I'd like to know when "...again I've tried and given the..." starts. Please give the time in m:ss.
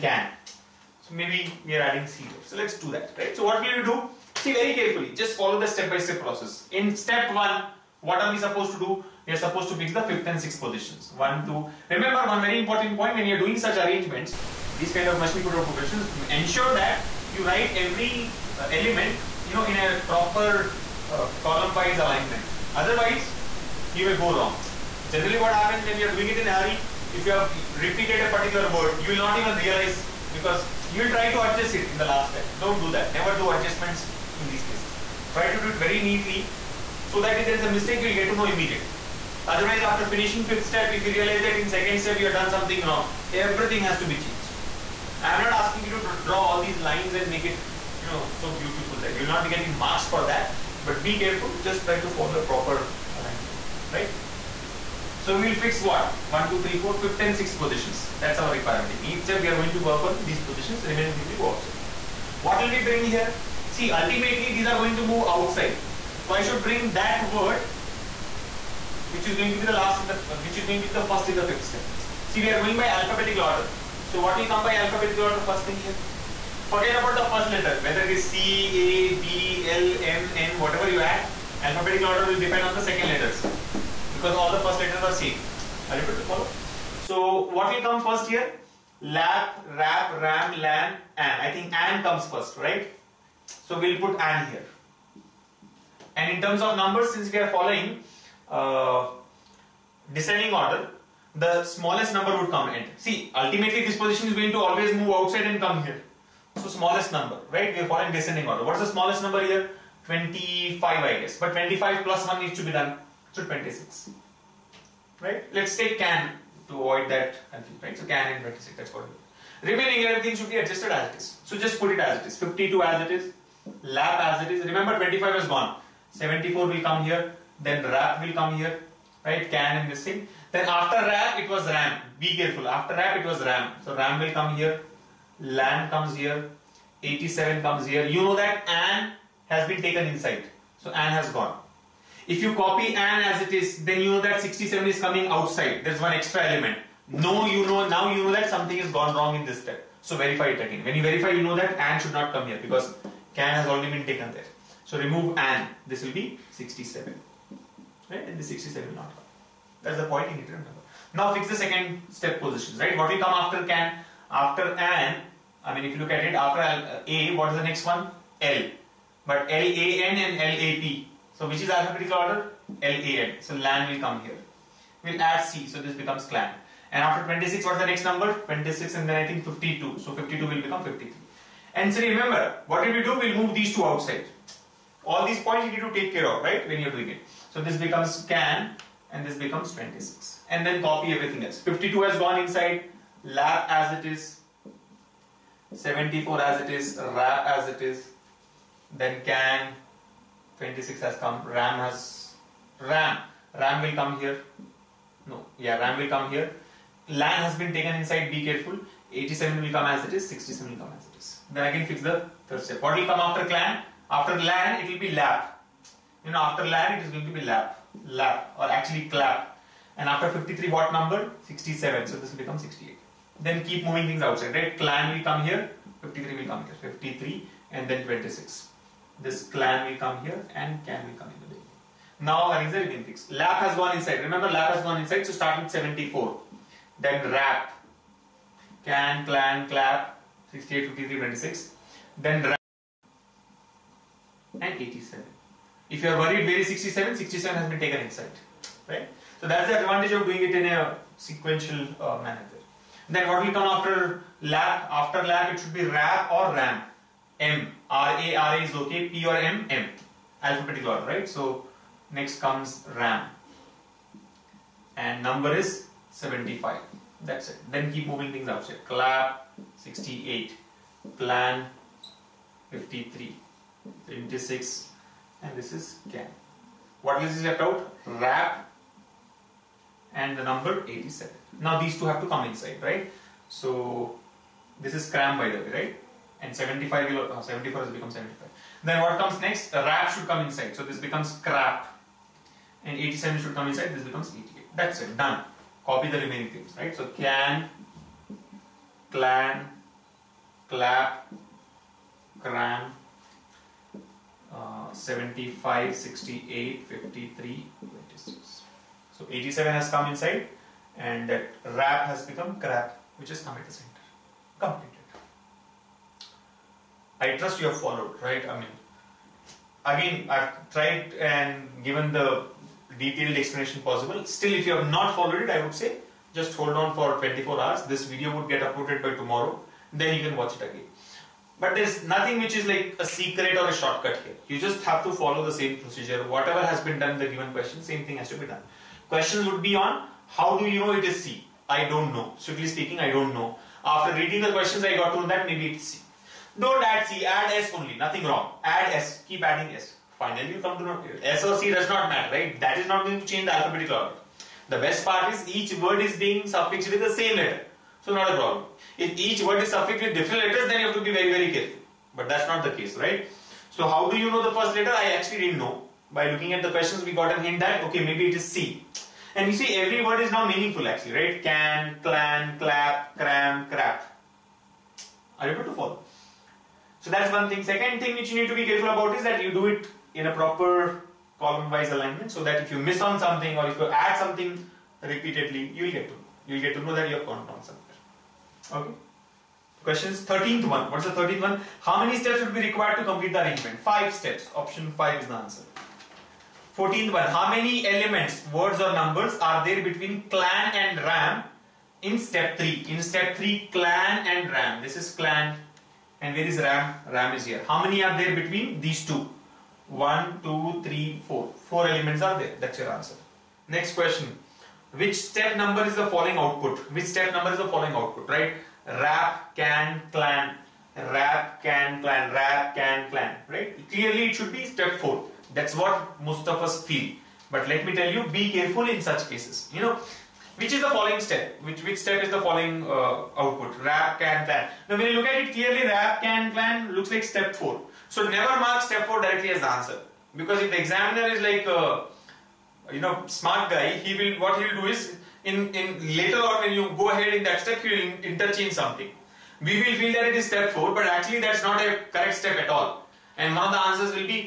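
5:19.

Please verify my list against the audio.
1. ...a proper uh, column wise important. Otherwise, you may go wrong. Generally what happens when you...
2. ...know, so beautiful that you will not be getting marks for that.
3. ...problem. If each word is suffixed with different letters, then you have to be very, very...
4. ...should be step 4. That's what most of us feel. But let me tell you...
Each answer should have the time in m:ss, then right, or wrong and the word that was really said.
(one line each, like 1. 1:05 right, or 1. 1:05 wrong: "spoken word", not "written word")
1. 0:19 wrong: "alignment", not "important"
2. 0:48 right
3. 5:58 right
4. 7:04 right.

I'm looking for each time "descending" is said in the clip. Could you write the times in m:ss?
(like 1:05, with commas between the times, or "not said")
1:40, 1:48.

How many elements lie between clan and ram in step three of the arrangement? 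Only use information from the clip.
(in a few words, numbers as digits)
Four.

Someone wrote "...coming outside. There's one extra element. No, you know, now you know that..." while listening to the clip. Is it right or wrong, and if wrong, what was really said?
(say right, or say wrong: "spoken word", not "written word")
right.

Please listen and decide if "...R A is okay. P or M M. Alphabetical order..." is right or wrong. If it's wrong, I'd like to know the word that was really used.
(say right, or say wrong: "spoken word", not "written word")
right.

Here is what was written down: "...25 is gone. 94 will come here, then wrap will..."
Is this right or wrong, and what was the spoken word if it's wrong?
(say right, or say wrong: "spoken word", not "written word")
wrong: "74", not "94".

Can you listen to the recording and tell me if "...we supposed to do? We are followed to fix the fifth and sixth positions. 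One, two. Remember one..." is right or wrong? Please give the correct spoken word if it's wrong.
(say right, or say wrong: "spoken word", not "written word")
wrong: "supposed", not "followed".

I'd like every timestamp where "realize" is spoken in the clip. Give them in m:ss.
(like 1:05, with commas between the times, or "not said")
0:29, 0:41.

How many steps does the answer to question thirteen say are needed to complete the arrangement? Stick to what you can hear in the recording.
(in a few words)
5 steps.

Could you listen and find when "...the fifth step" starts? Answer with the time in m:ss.
1:11.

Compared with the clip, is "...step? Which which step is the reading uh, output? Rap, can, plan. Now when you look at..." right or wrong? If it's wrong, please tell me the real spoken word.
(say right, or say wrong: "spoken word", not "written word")
wrong: "following", not "reading".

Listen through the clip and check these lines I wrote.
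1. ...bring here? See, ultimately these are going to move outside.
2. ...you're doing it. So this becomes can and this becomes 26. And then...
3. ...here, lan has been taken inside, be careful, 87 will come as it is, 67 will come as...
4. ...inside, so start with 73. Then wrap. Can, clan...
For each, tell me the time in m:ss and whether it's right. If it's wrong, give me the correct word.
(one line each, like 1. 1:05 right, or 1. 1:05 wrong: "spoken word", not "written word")
1. 1:02 right
2. 3:06 right
3. 3:26 right
4. 3:55 wrong: "74", not "73".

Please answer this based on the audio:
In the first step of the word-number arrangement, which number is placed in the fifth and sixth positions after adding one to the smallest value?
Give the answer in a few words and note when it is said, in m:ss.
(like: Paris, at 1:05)
26, at 1:53.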